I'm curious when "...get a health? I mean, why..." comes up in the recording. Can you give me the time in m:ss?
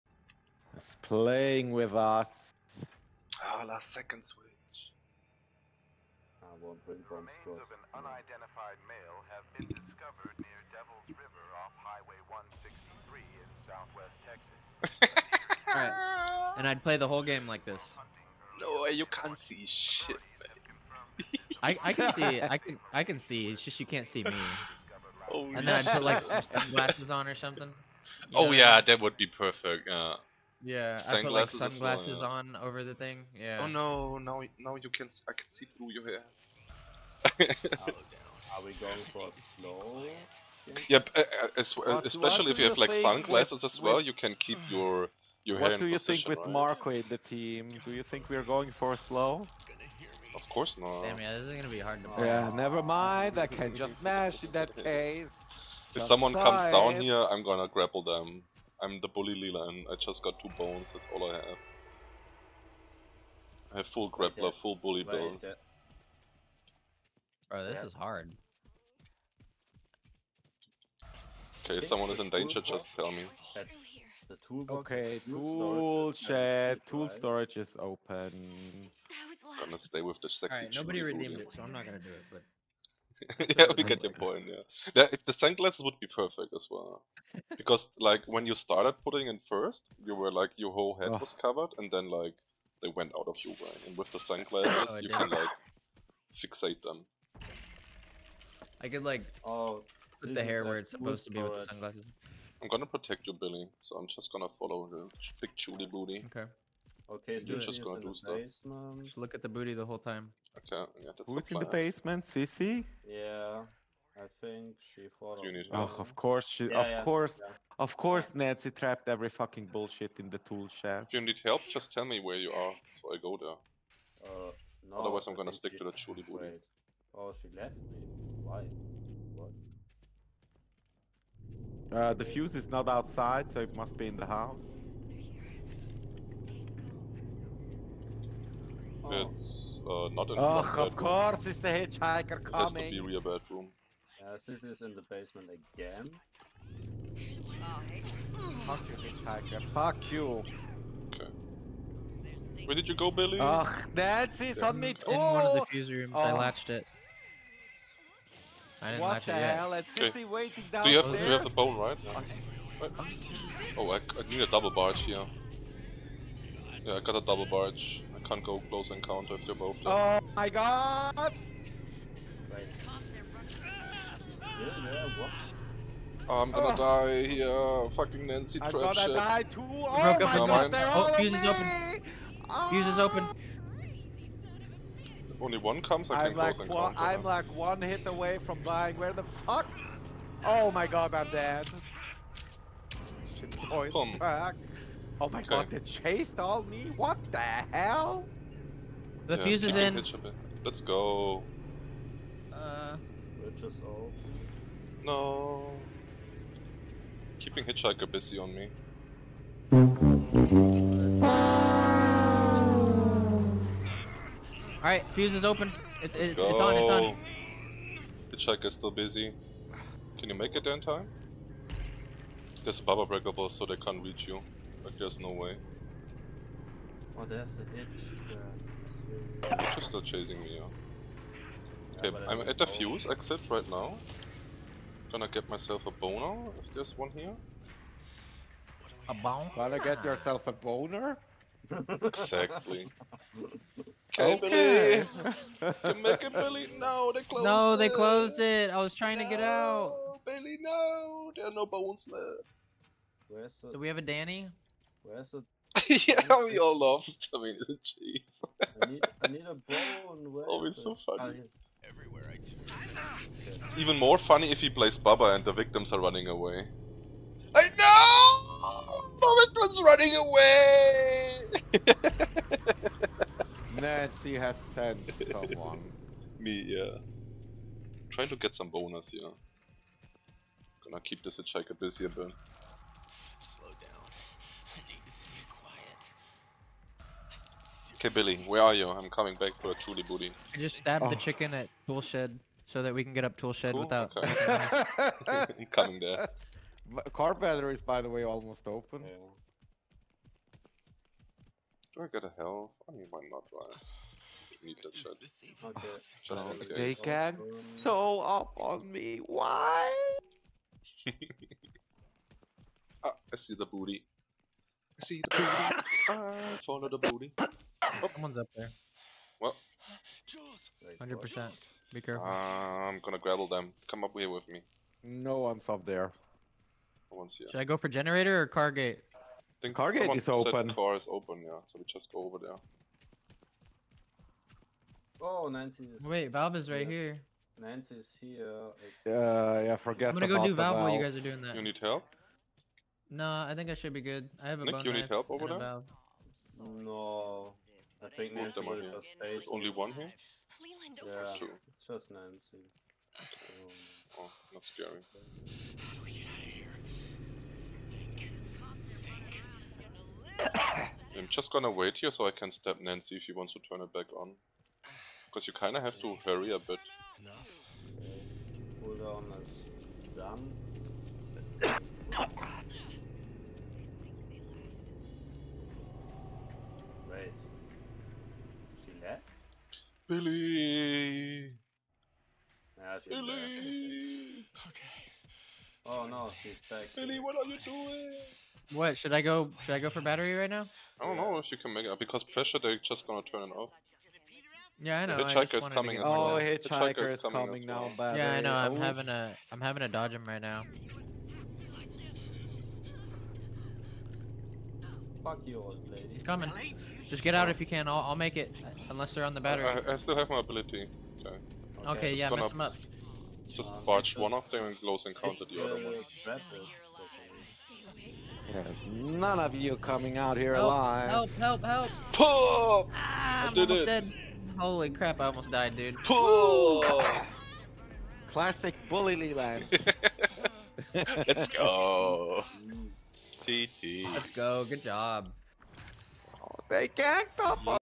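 5:02.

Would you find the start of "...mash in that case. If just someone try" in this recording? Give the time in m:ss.
0:54.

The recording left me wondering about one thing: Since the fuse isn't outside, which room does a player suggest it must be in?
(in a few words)
rear bedroom.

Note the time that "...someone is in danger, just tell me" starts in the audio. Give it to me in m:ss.
1:11.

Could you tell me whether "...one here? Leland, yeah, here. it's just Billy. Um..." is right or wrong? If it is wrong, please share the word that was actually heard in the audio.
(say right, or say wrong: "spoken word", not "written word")
wrong: "Nancy", not "Billy".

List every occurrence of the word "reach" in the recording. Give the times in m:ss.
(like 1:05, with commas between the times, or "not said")
3:44.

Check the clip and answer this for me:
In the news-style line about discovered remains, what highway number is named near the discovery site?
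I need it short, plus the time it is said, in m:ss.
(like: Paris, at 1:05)
163, at 0:12.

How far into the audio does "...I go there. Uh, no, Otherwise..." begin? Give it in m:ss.
2:03.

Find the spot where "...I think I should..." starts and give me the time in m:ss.
5:43.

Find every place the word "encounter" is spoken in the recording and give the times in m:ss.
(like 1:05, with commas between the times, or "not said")
2:48, 6:55.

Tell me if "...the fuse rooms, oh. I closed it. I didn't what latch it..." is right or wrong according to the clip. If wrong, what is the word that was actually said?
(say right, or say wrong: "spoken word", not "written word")
wrong: "latched", not "closed".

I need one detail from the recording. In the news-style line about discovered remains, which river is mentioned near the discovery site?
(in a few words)
Devil's River.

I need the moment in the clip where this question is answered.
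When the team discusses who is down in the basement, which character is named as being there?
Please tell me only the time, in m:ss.
1:52.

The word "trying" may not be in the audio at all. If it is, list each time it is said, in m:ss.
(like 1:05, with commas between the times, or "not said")
4:08, 4:38.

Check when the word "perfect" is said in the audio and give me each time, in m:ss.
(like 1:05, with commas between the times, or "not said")
0:29, 1:26.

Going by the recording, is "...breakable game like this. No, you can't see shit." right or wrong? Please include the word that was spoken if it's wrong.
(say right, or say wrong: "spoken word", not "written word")
wrong: "whole", not "breakable".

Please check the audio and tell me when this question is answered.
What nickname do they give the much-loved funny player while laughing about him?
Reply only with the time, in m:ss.
4:17.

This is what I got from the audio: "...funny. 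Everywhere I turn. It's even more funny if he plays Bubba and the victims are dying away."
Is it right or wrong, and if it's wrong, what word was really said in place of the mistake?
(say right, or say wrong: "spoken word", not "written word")
wrong: "running", not "dying".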